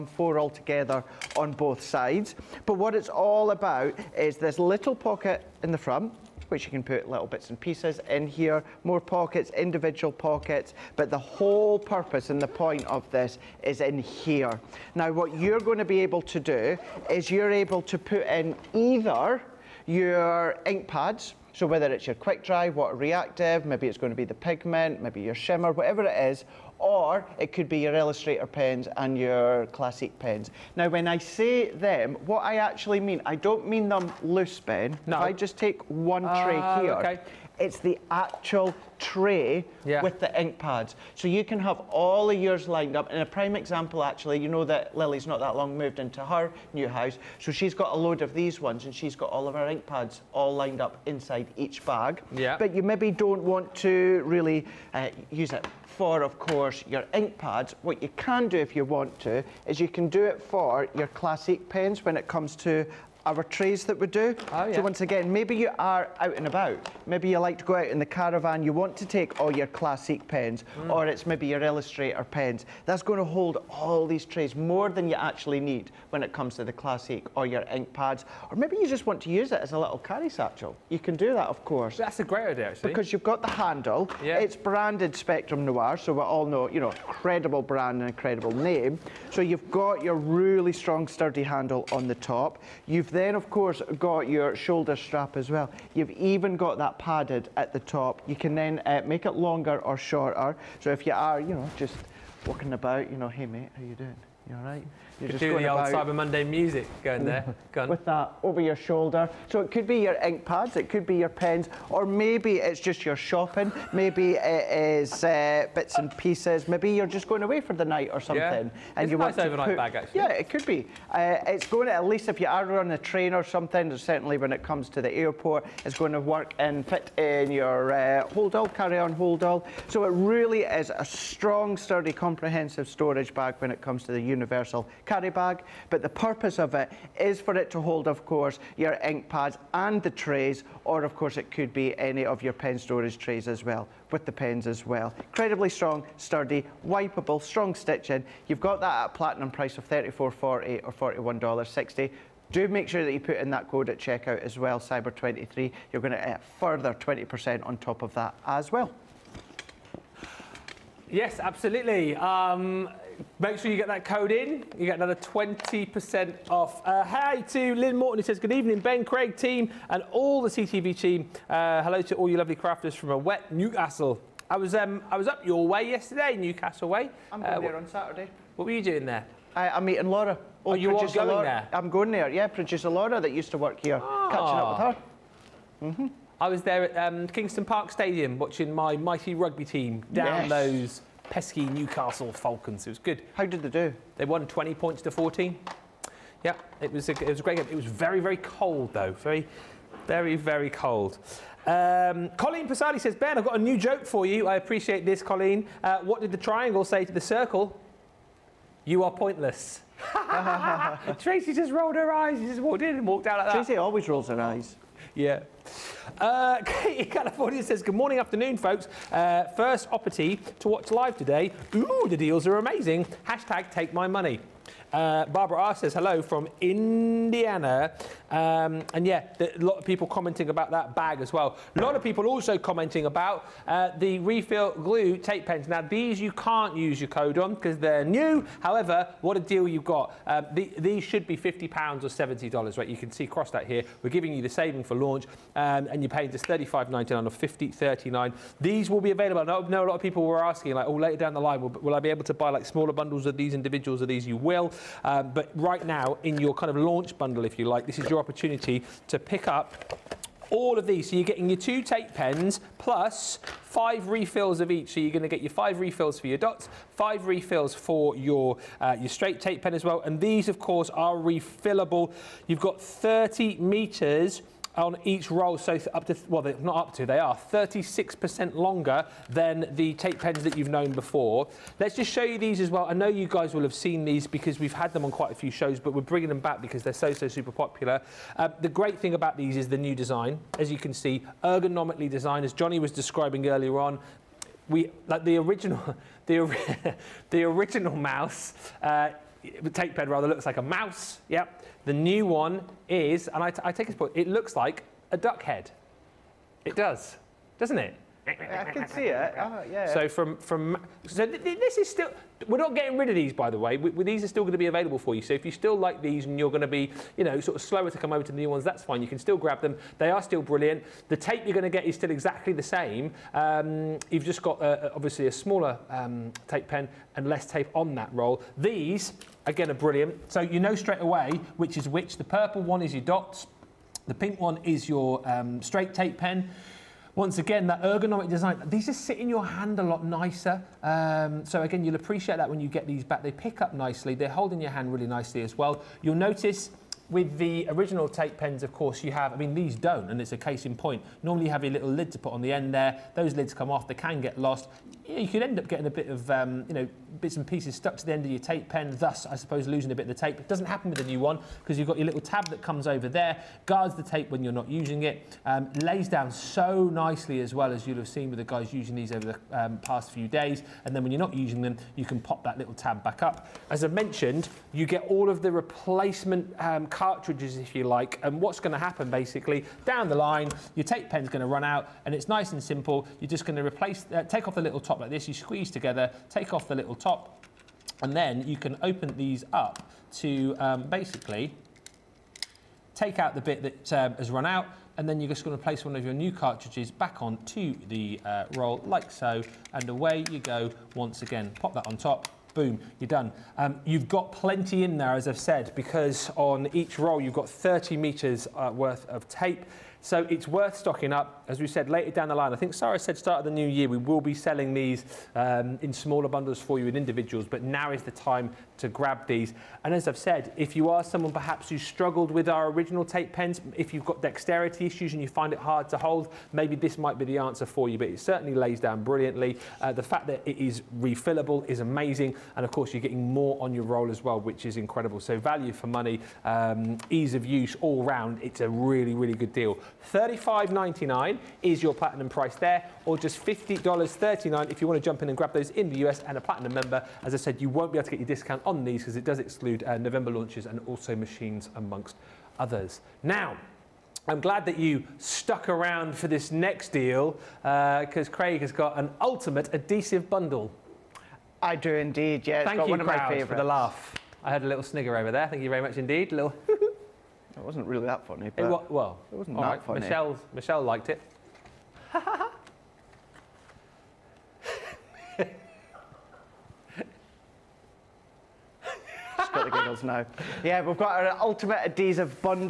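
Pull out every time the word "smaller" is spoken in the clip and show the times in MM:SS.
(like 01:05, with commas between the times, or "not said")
04:12, 05:25, 06:55.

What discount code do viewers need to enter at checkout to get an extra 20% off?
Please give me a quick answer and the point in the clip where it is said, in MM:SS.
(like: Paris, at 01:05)
Cyber23, at 02:34.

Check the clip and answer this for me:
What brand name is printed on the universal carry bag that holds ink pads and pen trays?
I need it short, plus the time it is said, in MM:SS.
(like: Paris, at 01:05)
Spectrum Noir, at 01:25.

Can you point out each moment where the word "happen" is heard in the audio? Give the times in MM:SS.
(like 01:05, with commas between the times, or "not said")
06:00, 06:18.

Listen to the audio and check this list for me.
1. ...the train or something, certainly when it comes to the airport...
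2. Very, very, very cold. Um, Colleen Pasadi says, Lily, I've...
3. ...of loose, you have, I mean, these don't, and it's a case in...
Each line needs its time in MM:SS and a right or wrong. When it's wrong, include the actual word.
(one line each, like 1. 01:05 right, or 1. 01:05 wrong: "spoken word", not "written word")
1. 02:02 right
2. 03:19 wrong: "Ben", not "Lily"
3. 05:48 wrong: "course", not "loose".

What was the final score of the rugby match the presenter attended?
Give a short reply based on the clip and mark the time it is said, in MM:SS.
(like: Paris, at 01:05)
20 points to 14, at 03:14.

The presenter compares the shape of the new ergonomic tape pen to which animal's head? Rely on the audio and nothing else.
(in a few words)
a duck.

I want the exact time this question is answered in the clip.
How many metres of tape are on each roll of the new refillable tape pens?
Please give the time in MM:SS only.
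04:32.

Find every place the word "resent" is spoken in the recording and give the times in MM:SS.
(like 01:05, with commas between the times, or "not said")
not said.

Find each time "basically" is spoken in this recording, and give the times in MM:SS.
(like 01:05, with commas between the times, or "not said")
06:19, 06:30.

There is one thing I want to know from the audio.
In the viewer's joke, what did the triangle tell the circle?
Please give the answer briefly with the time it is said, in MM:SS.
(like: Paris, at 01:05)
You are pointless, at 03:28.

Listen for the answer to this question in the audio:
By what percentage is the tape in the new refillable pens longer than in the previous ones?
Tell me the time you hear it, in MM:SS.
04:37.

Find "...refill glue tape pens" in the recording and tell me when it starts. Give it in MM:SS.
03:54.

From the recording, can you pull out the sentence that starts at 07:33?
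Now, I'm glad that you stuck around for this next deal because uh, Craig has got an ultimate adhesive bundle.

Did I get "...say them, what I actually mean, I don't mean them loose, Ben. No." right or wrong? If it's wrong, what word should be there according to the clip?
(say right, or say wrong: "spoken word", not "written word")
right.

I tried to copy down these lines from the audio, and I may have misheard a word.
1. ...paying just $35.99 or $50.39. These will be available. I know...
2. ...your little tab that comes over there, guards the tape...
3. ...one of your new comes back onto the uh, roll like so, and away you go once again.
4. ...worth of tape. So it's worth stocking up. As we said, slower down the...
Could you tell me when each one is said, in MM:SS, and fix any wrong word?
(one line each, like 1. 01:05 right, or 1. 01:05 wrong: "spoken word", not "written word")
1. 04:06 right
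2. 06:01 right
3. 06:35 wrong: "cartridges", not "comes"
4. 06:48 wrong: "later", not "slower".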